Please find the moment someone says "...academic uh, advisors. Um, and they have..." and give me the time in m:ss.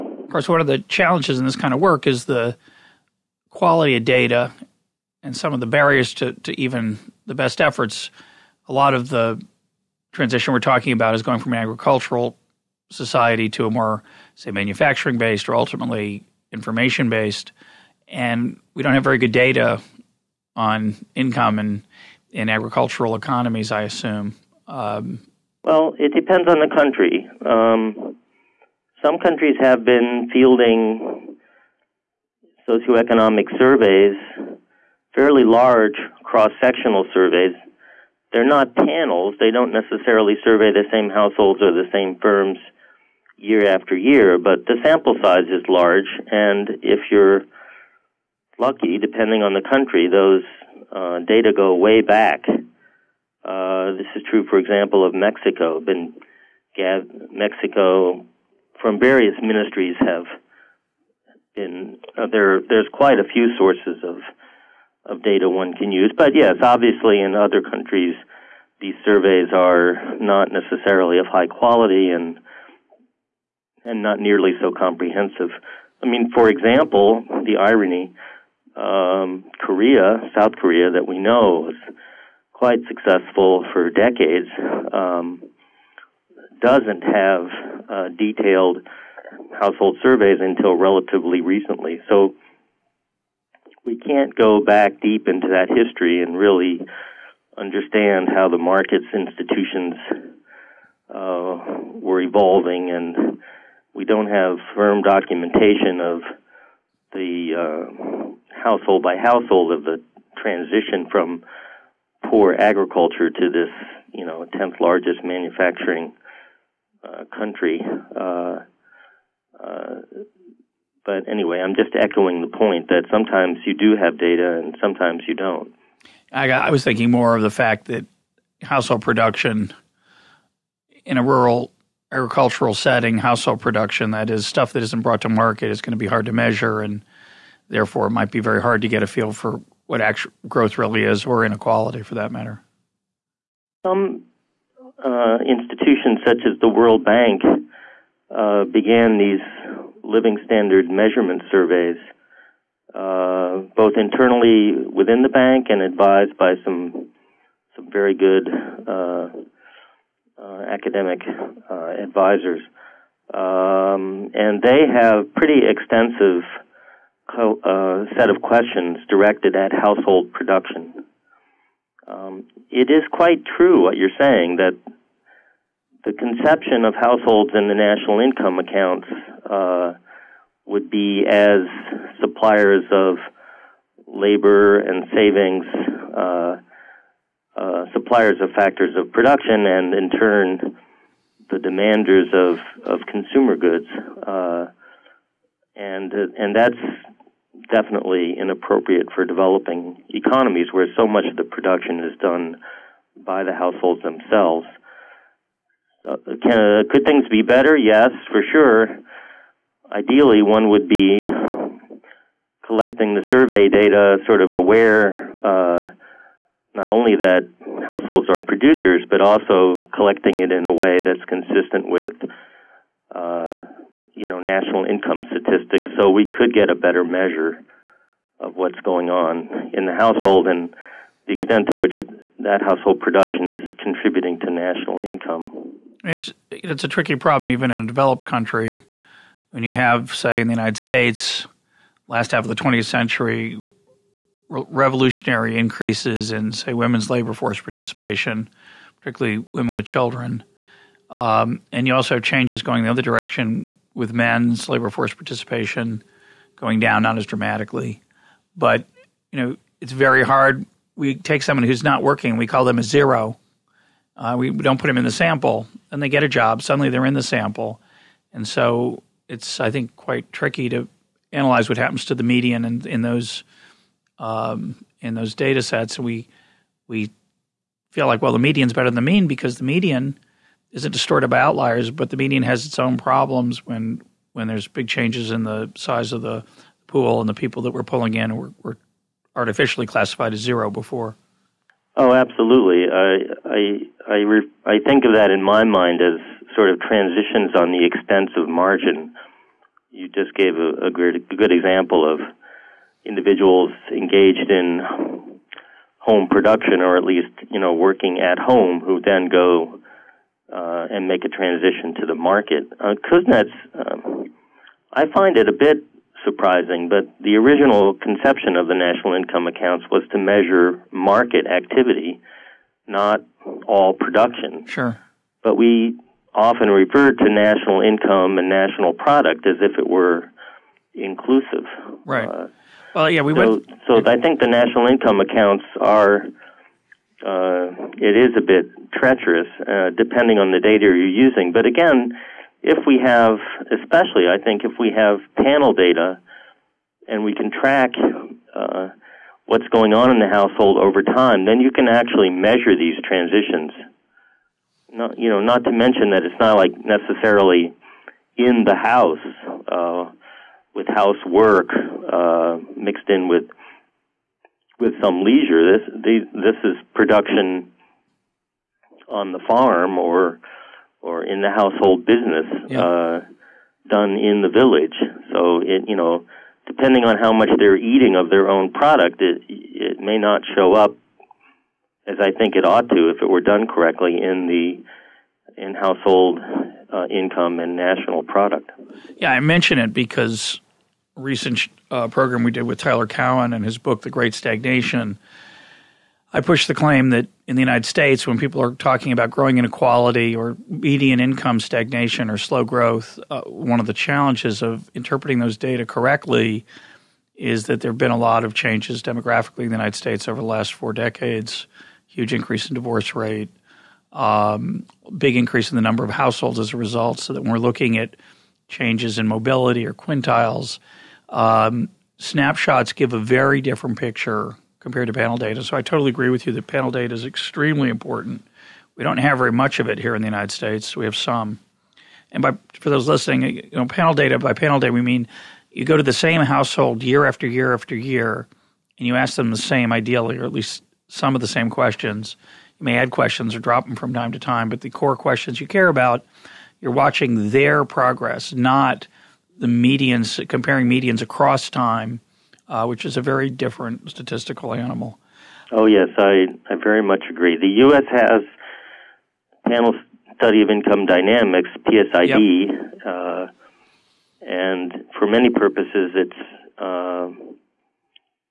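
2:40.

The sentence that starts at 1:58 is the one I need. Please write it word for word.
Uh, uh, but anyway, I'm just echoing the point that sometimes you do have data and sometimes you don't.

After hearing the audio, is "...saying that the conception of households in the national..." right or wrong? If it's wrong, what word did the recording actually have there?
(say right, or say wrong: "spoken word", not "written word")
right.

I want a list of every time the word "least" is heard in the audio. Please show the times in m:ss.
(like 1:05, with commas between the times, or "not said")
5:07, 7:20.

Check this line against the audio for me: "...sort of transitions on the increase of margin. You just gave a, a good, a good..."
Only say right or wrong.
wrong.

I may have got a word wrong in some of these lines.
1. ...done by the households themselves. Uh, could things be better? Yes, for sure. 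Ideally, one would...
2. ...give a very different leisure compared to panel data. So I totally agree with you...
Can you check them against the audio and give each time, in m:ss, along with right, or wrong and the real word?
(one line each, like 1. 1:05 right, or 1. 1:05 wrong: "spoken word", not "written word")
1. 3:22 right
2. 7:02 wrong: "picture", not "leisure".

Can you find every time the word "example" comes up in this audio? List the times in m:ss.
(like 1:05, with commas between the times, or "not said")
0:54, 1:16, 5:01.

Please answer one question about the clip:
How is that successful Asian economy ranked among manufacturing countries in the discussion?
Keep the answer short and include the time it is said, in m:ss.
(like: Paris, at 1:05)
tenth largest, at 1:54.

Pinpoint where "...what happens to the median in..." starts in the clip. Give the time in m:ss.
4:31.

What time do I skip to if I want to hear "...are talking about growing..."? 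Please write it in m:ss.
6:38.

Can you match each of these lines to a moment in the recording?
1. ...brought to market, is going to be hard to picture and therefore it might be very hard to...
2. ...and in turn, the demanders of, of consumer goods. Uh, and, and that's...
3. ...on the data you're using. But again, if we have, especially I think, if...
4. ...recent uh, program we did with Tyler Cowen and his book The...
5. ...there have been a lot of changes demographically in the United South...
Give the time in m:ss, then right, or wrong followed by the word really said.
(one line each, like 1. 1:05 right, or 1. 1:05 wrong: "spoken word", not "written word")
1. 2:15 wrong: "measure", not "picture"
2. 3:09 right
3. 5:40 right
4. 6:31 right
5. 6:47 wrong: "States", not "South".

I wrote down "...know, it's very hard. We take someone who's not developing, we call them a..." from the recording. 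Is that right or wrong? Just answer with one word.
wrong.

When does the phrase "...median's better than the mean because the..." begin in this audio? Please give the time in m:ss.
4:38.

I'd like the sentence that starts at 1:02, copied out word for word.
There's quite a few sources of of data one can use.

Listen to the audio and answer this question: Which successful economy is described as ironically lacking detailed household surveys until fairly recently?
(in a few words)
South Korea.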